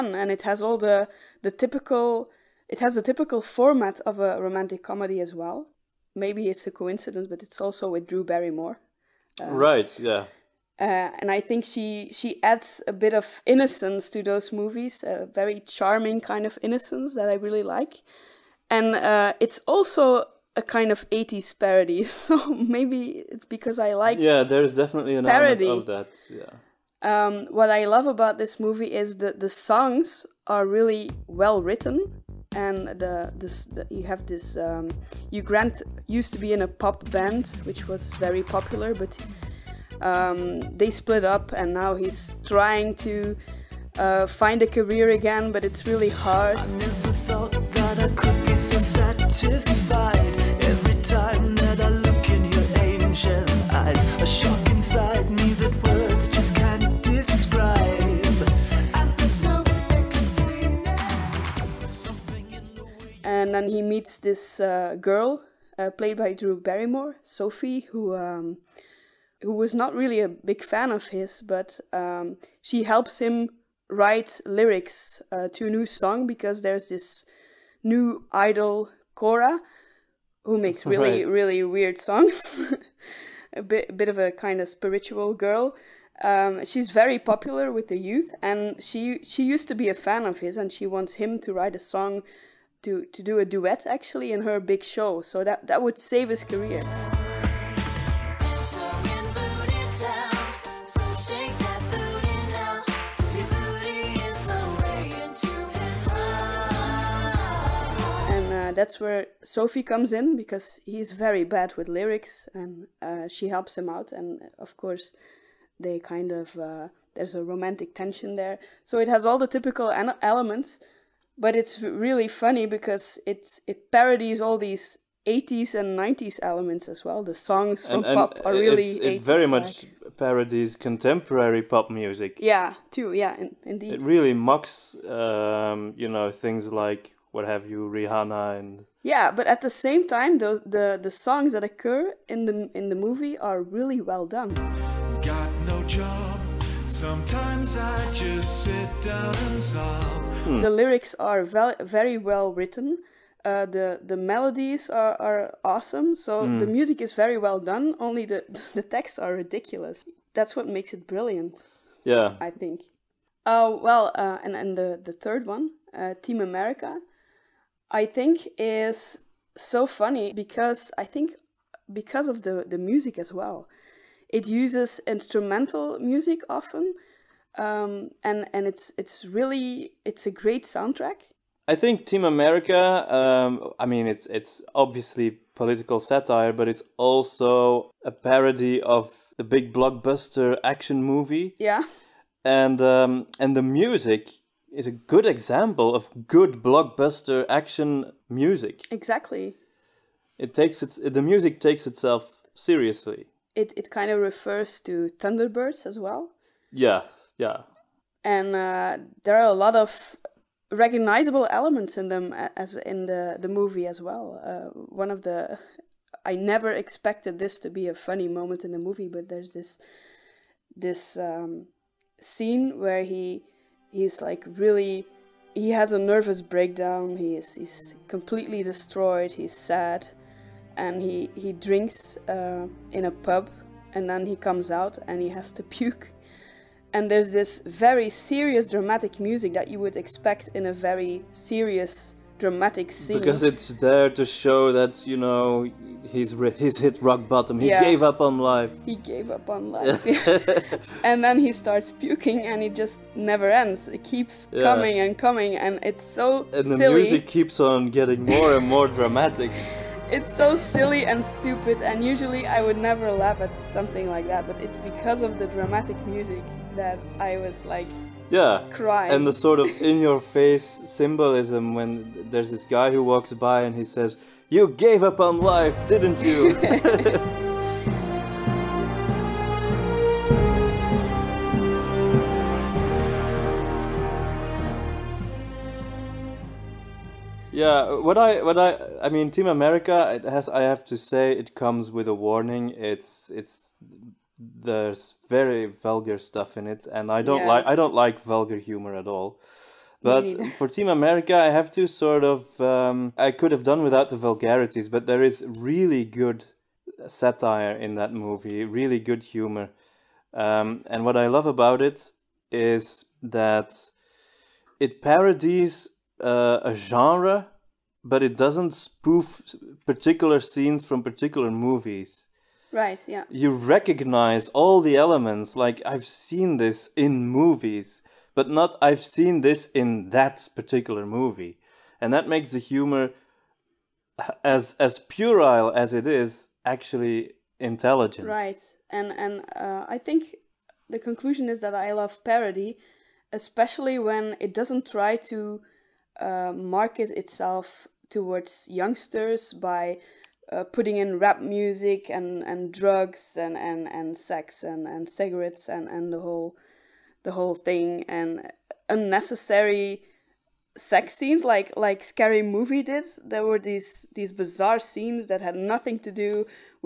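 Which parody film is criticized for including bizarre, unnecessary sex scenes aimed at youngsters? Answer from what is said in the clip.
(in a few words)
Scary Movie.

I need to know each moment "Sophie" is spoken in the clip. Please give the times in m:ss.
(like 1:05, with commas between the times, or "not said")
1:07, 1:49.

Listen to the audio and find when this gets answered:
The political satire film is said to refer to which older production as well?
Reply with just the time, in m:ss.
3:25.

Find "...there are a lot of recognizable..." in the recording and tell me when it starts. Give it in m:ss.
3:29.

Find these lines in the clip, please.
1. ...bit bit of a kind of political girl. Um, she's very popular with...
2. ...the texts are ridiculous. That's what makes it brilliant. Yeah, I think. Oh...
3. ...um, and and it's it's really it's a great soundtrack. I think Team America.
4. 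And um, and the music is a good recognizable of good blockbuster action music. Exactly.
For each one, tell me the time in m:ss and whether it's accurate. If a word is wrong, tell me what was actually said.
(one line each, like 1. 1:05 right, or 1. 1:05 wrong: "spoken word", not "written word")
1. 1:23 wrong: "spiritual", not "political"
2. 2:38 right
3. 2:57 right
4. 3:12 wrong: "example", not "recognizable".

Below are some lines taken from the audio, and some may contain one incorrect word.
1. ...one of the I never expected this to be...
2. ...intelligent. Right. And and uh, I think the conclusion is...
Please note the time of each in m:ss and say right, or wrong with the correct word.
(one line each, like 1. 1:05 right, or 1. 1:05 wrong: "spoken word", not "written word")
1. 3:34 right
2. 5:37 right.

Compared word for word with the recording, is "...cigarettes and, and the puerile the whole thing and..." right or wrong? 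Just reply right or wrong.
wrong.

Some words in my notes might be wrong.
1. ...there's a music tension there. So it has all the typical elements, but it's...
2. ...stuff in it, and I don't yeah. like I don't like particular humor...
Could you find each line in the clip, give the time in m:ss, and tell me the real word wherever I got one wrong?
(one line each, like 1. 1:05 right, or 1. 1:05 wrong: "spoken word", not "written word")
1. 1:57 wrong: "romantic", not "music"
2. 4:56 wrong: "vulgar", not "particular".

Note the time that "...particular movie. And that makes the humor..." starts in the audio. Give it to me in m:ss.
5:30.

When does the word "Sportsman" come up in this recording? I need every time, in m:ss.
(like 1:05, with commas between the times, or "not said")
not said.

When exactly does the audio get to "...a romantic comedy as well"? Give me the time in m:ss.
0:04.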